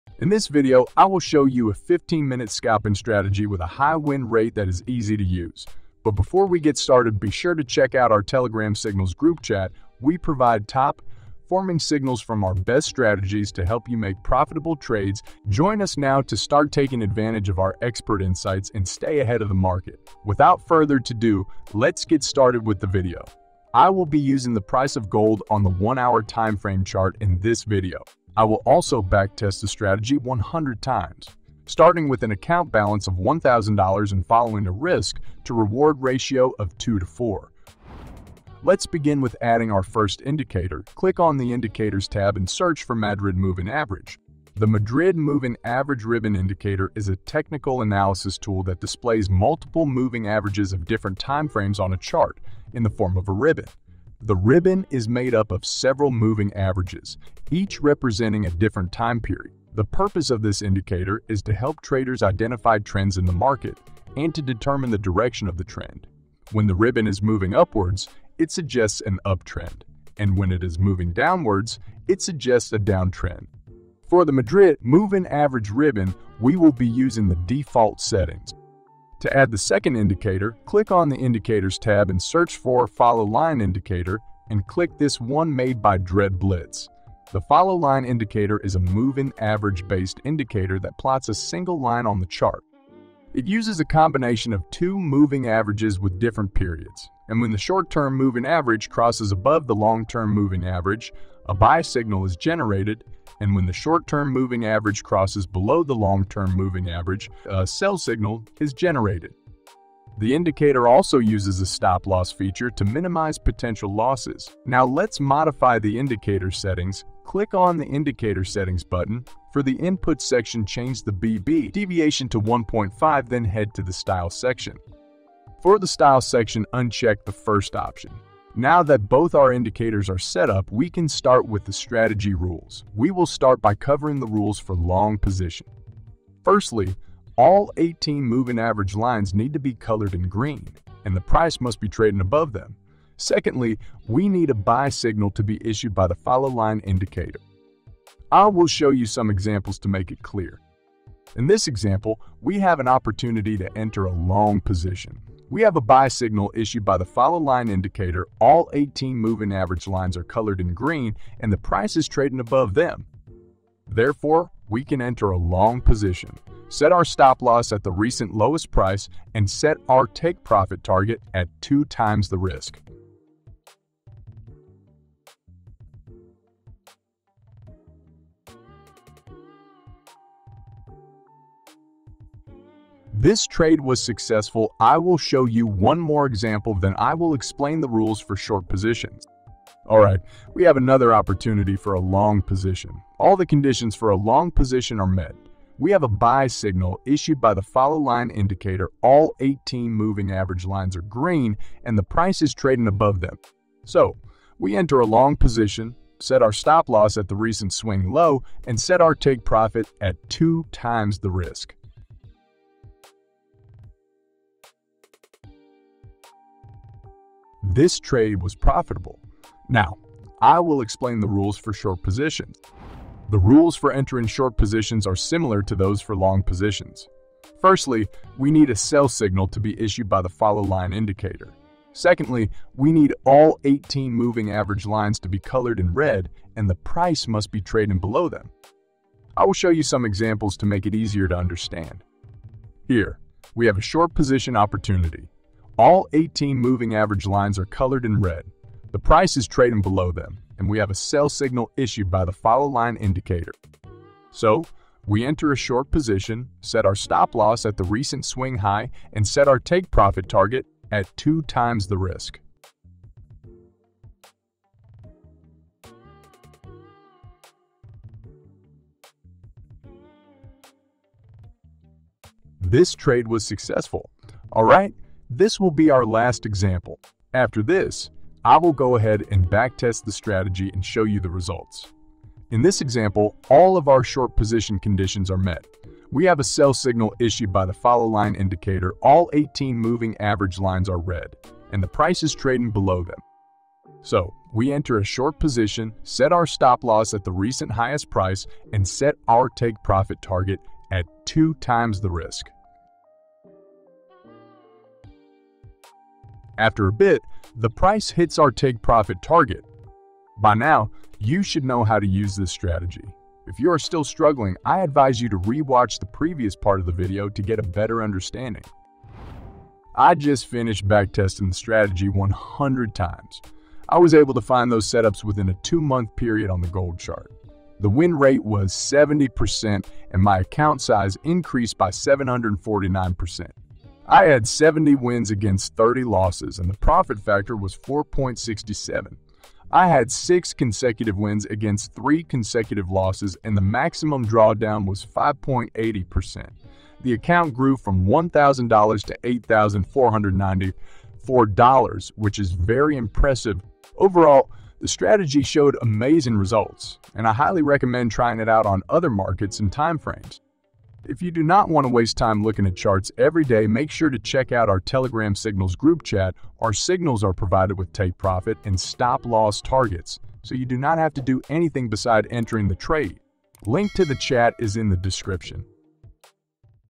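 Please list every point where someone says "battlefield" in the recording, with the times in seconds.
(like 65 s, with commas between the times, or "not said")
not said.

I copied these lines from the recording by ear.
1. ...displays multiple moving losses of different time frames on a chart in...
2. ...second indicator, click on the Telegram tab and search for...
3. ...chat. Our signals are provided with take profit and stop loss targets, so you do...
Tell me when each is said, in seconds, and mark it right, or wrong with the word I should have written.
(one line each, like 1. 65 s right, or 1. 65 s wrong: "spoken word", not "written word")
1. 48 s wrong: "averages", not "losses"
2. 79 s wrong: "Indicators", not "Telegram"
3. 366 s right.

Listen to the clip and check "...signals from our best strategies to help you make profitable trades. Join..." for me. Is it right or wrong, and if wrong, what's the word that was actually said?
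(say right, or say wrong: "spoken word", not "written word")
right.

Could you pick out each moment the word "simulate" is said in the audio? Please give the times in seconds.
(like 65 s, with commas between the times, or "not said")
not said.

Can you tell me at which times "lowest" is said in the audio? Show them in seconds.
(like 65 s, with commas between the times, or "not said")
168 s.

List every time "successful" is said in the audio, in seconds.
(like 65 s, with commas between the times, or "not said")
184 s, 273 s.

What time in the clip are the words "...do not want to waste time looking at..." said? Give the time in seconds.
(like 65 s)
361 s.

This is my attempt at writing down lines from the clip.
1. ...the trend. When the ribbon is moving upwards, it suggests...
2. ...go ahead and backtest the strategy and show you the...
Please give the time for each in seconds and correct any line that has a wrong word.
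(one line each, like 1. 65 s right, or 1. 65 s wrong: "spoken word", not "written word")
1. 65 s right
2. 278 s right.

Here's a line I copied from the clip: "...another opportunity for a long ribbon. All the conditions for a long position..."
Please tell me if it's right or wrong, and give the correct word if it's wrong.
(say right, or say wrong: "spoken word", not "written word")
wrong: "position", not "ribbon".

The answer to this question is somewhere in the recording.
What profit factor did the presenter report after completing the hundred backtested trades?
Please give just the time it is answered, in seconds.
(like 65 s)
337 s.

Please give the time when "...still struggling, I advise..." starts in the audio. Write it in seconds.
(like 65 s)
313 s.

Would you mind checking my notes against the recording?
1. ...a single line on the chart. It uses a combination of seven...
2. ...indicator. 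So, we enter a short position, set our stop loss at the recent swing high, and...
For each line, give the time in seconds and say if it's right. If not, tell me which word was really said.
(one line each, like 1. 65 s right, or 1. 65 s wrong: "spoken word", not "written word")
1. 91 s wrong: "two", not "seven"
2. 252 s right.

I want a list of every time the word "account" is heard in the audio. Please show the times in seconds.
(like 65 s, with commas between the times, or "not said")
32 s, 330 s, 347 s.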